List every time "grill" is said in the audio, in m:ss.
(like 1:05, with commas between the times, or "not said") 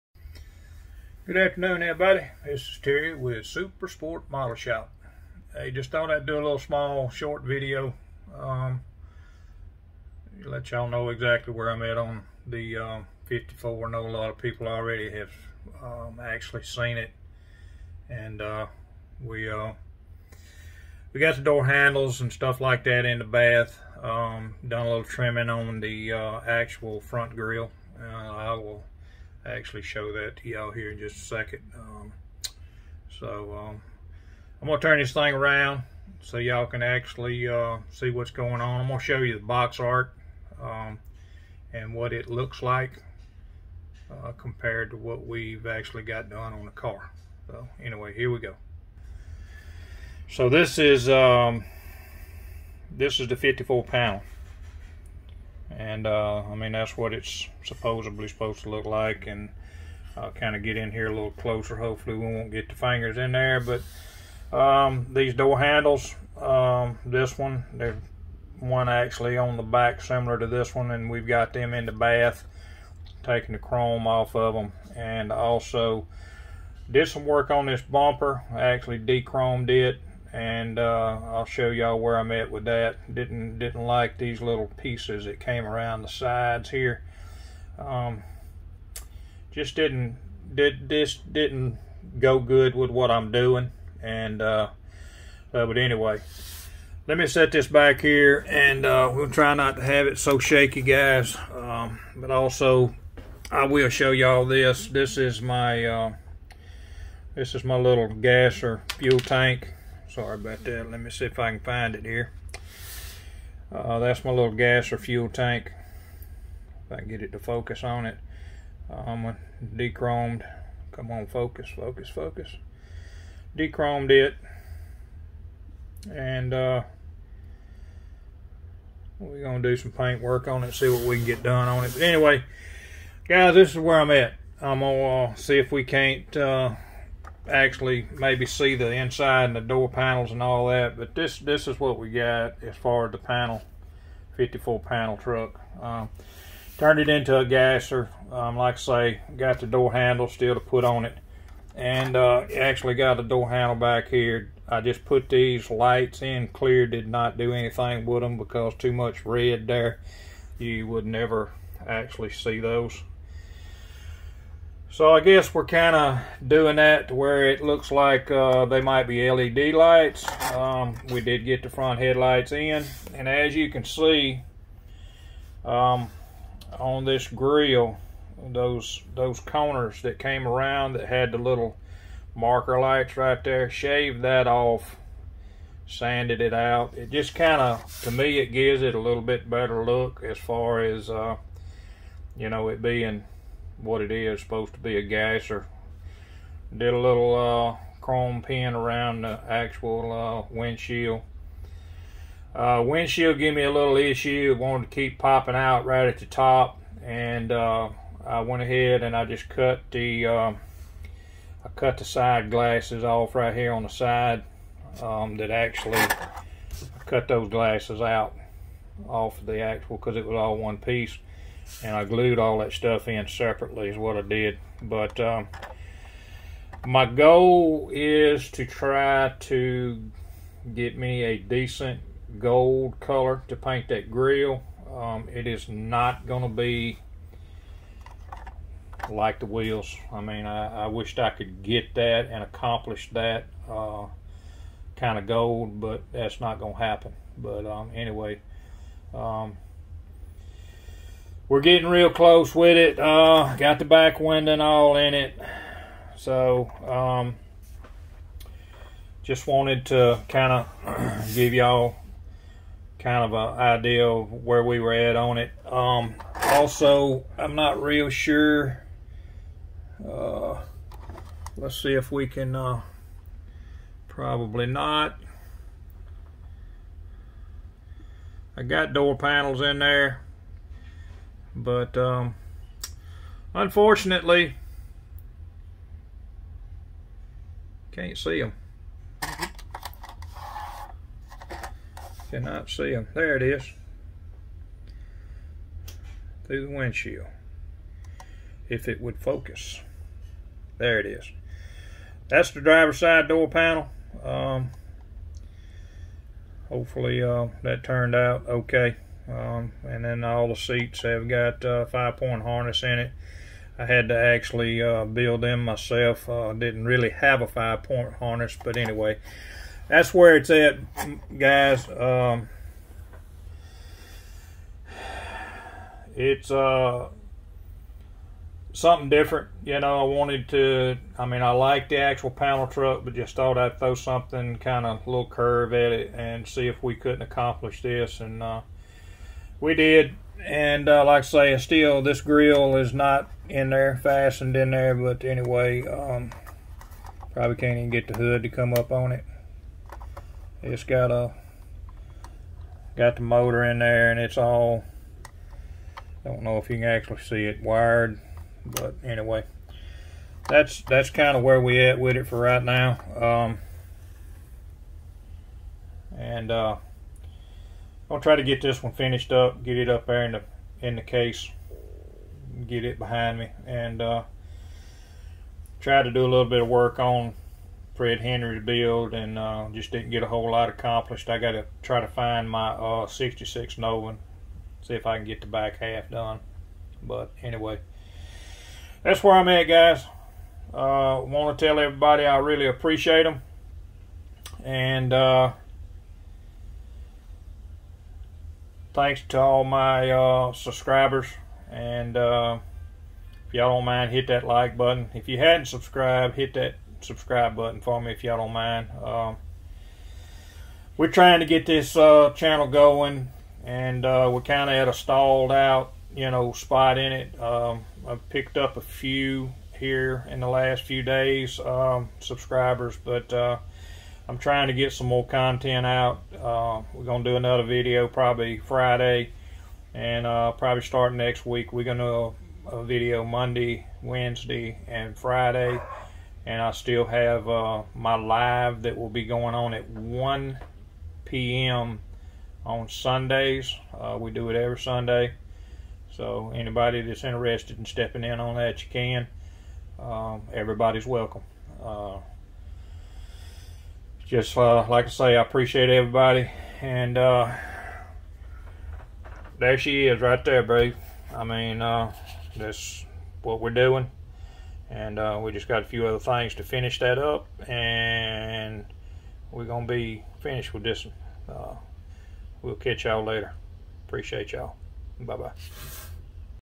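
0:27, 2:57, 3:54, 5:42.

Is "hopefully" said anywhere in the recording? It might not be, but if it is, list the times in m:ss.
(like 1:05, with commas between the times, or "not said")
1:01, 5:06.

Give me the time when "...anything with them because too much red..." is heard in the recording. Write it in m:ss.
2:37.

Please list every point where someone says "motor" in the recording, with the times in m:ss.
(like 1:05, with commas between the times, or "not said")
5:53.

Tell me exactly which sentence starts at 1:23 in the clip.
Didn't didn't like these little pieces that came around the sides here.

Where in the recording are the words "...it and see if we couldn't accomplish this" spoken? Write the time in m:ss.
5:35.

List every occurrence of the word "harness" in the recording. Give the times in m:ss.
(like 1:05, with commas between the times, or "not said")
5:12, 5:18.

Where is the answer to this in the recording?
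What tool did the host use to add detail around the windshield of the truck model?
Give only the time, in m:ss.
3:18.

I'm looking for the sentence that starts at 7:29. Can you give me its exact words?
Um, everybody's welcome just uh, like I say, I appreciate everybody.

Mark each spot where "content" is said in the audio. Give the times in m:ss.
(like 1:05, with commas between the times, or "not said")
7:05.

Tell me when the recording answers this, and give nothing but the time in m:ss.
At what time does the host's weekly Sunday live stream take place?
7:19.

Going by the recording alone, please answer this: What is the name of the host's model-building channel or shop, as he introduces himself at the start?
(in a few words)
Super Sport Model Shop.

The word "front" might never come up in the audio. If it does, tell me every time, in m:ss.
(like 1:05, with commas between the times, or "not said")
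0:26, 2:51.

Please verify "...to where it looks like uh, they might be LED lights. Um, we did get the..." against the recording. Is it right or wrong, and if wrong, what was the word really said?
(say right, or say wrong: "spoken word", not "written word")
right.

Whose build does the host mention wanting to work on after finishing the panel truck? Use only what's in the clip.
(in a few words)
Fred Henry.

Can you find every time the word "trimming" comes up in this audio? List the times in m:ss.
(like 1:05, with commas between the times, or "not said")
0:25.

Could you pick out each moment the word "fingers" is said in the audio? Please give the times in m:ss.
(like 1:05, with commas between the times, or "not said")
1:02.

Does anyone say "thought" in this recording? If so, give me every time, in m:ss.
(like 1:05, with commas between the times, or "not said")
0:05, 5:33.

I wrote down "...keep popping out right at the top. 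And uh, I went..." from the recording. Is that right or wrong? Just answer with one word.
right.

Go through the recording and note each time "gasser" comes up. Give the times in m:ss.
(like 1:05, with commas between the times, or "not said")
2:27, 3:15.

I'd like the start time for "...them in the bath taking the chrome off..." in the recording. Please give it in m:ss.
1:11.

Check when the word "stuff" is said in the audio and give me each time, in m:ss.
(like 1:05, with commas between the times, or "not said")
0:22, 3:42.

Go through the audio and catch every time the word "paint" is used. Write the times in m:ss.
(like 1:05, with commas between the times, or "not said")
2:09, 3:53.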